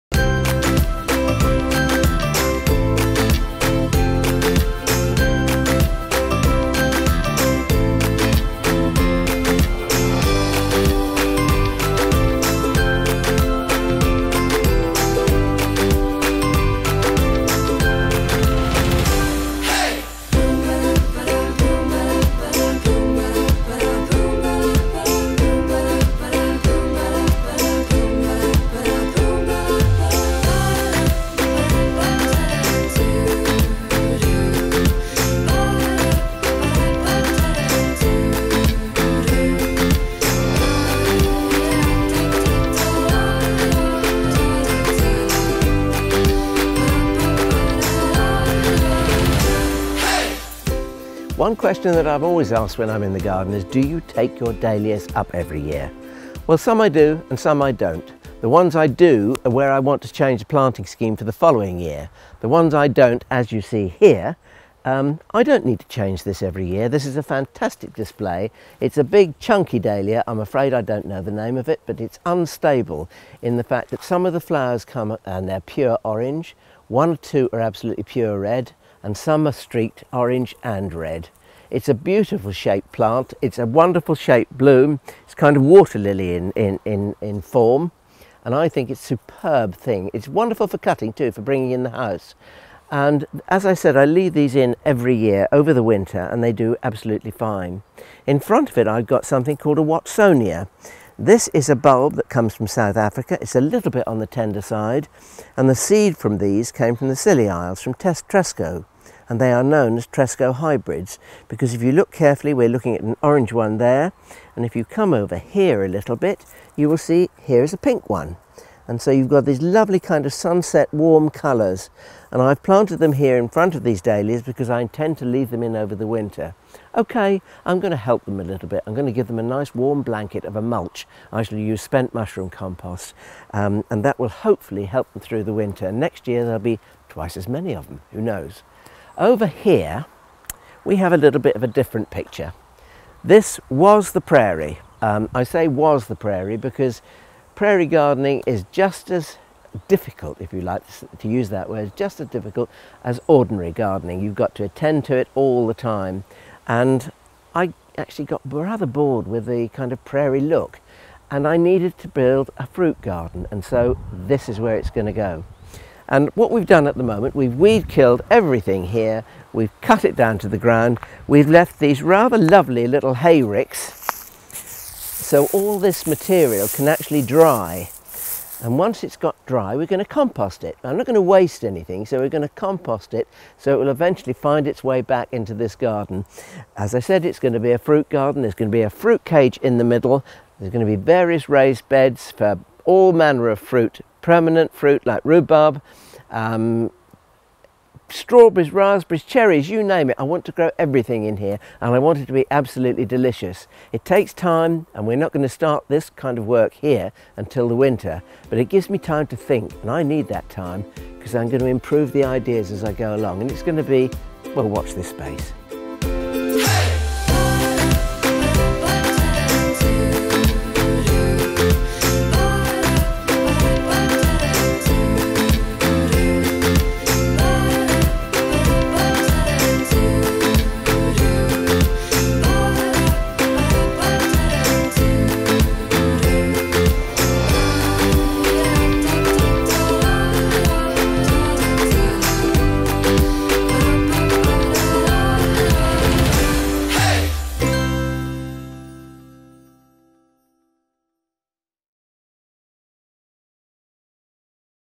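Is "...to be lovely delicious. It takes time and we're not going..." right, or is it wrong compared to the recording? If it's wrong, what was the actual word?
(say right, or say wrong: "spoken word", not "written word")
wrong: "absolutely", not "lovely".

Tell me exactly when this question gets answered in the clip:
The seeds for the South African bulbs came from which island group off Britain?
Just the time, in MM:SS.
01:47.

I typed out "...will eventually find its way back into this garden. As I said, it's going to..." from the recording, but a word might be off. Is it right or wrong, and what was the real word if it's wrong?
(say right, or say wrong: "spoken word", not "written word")
right.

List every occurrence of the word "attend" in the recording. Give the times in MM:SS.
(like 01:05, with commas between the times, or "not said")
02:34.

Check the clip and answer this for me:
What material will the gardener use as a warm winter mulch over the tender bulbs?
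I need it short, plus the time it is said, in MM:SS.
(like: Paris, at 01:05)
Spent mushroom compost, at 02:11.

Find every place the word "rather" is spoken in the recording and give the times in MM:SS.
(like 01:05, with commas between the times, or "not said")
02:38, 02:52.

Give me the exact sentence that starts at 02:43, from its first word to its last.
And so this is where it's going to go.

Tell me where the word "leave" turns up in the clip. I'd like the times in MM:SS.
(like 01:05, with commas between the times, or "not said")
01:34, 02:05.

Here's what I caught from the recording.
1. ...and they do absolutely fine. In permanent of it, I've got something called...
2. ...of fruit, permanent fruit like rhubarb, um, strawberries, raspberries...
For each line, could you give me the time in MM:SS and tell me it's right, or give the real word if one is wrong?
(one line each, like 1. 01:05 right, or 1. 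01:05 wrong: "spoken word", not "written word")
1. 01:36 wrong: "front", not "permanent"
2. 03:13 right.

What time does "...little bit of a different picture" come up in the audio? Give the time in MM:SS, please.
02:21.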